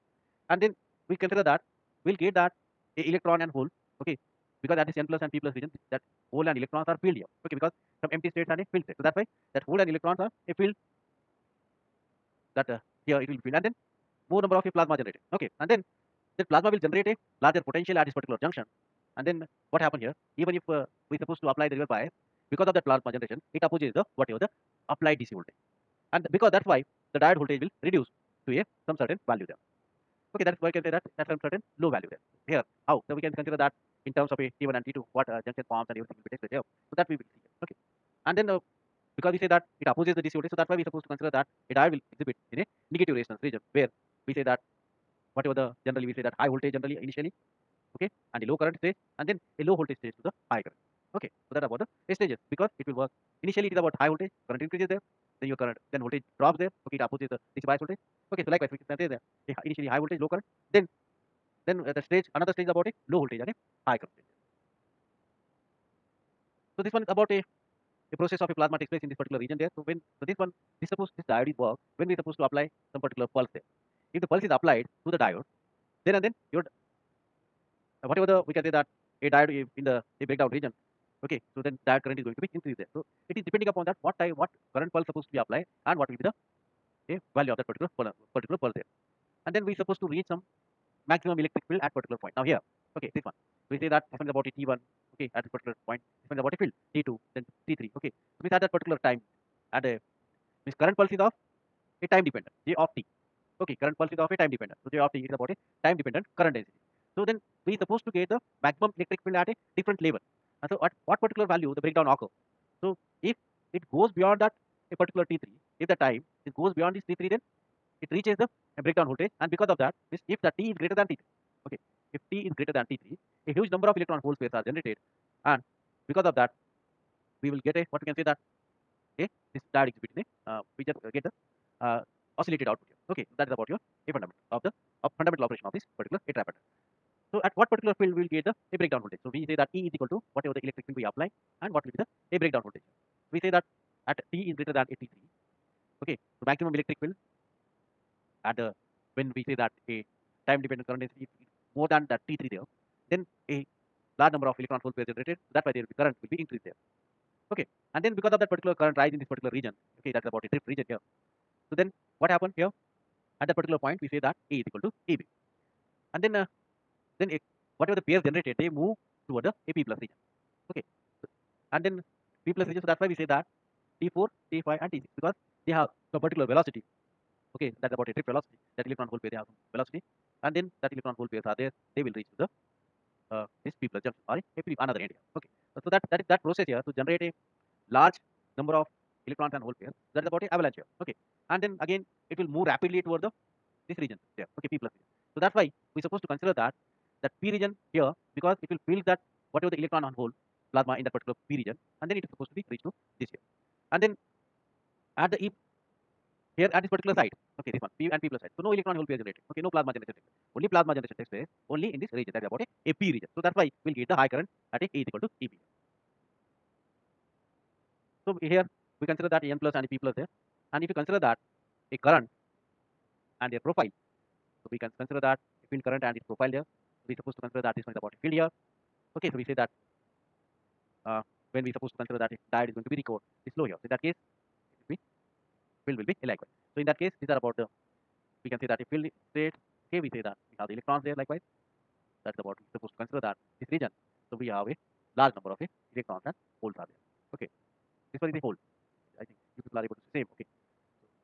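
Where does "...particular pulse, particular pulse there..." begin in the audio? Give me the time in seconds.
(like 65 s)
87 s.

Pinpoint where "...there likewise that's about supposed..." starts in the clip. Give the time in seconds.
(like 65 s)
241 s.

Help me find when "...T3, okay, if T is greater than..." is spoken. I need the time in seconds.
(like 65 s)
121 s.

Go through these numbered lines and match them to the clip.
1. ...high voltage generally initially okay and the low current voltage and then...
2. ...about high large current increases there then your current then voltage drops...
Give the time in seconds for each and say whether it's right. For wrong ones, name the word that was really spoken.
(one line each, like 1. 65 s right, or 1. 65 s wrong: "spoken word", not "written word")
1. 46 s wrong: "stage", not "voltage"
2. 53 s wrong: "voltage", not "large".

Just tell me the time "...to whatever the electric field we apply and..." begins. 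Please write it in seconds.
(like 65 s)
140 s.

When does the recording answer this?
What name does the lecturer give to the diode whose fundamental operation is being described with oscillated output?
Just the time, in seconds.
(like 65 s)
136 s.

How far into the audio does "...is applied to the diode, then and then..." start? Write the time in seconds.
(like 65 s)
74 s.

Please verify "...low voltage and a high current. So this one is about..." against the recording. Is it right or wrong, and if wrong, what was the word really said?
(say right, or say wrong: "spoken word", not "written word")
right.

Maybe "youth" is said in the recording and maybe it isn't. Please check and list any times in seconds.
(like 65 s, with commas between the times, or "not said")
not said.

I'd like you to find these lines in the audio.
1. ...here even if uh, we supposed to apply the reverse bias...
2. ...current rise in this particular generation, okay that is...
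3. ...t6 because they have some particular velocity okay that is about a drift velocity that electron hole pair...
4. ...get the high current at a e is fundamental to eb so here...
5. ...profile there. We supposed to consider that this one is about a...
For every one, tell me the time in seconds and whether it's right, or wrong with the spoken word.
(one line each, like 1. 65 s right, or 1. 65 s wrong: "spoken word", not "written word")
1. 20 s right
2. 158 s wrong: "region", not "generation"
3. 174 s right
4. 213 s wrong: "equal", not "fundamental"
5. 226 s right.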